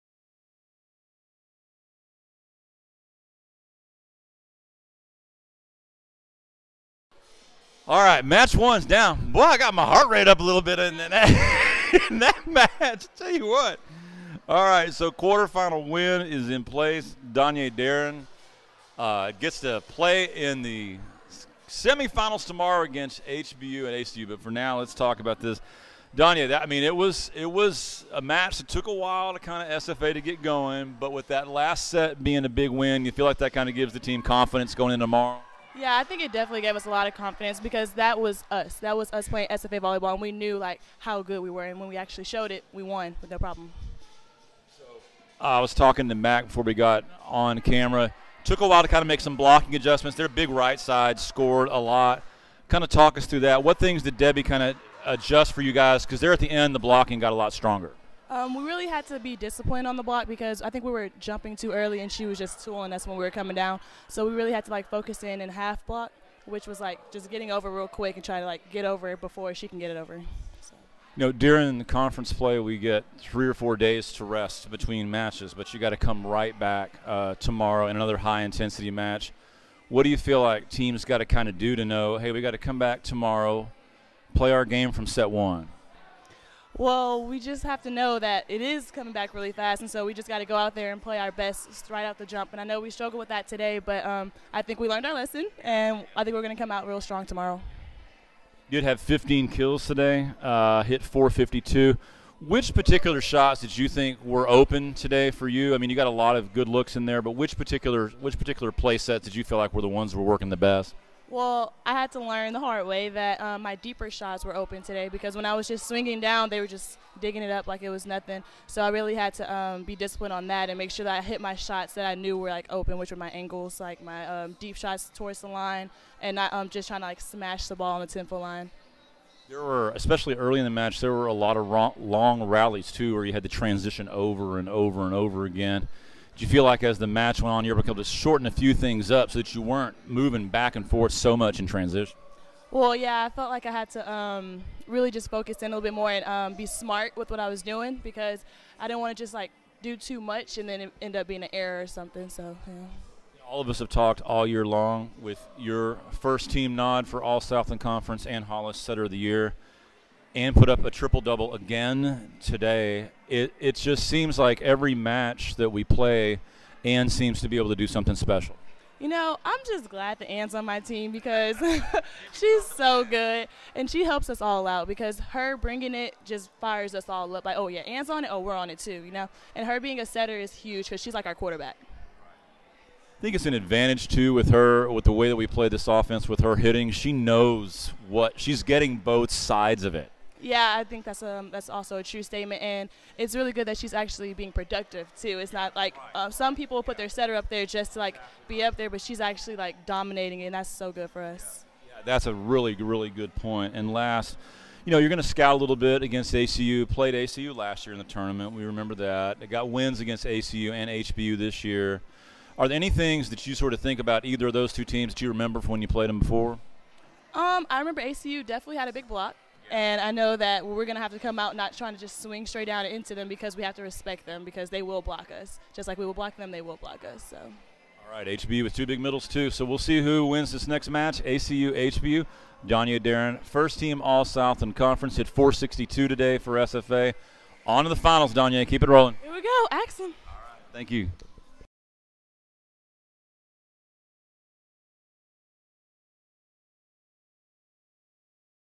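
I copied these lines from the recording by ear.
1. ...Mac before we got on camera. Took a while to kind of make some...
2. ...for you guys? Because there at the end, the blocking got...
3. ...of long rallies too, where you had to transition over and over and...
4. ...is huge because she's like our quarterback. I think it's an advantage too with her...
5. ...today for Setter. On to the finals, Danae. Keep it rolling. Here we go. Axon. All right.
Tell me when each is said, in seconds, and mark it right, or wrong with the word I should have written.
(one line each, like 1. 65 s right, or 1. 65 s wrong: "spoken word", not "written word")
1. 46 s right
2. 55 s right
3. 131 s right
4. 180 s right
5. 236 s wrong: "SFA", not "Setter".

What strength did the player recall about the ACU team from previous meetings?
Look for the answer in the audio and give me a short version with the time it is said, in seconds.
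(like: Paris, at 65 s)
a big block, at 218 s.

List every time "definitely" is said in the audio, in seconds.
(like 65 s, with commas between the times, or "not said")
36 s, 218 s.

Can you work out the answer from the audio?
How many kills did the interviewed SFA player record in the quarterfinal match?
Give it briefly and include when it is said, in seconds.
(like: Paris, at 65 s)
15, at 99 s.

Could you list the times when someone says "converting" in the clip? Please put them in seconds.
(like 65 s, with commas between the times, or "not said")
not said.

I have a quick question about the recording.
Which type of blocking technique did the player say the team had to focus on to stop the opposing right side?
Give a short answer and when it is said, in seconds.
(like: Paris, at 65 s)
half block, at 65 s.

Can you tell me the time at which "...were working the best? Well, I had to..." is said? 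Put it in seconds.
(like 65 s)
110 s.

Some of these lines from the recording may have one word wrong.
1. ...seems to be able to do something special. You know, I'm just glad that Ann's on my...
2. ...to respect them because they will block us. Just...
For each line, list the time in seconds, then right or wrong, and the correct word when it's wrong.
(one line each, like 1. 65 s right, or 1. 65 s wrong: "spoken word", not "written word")
1. 167 s right
2. 223 s right.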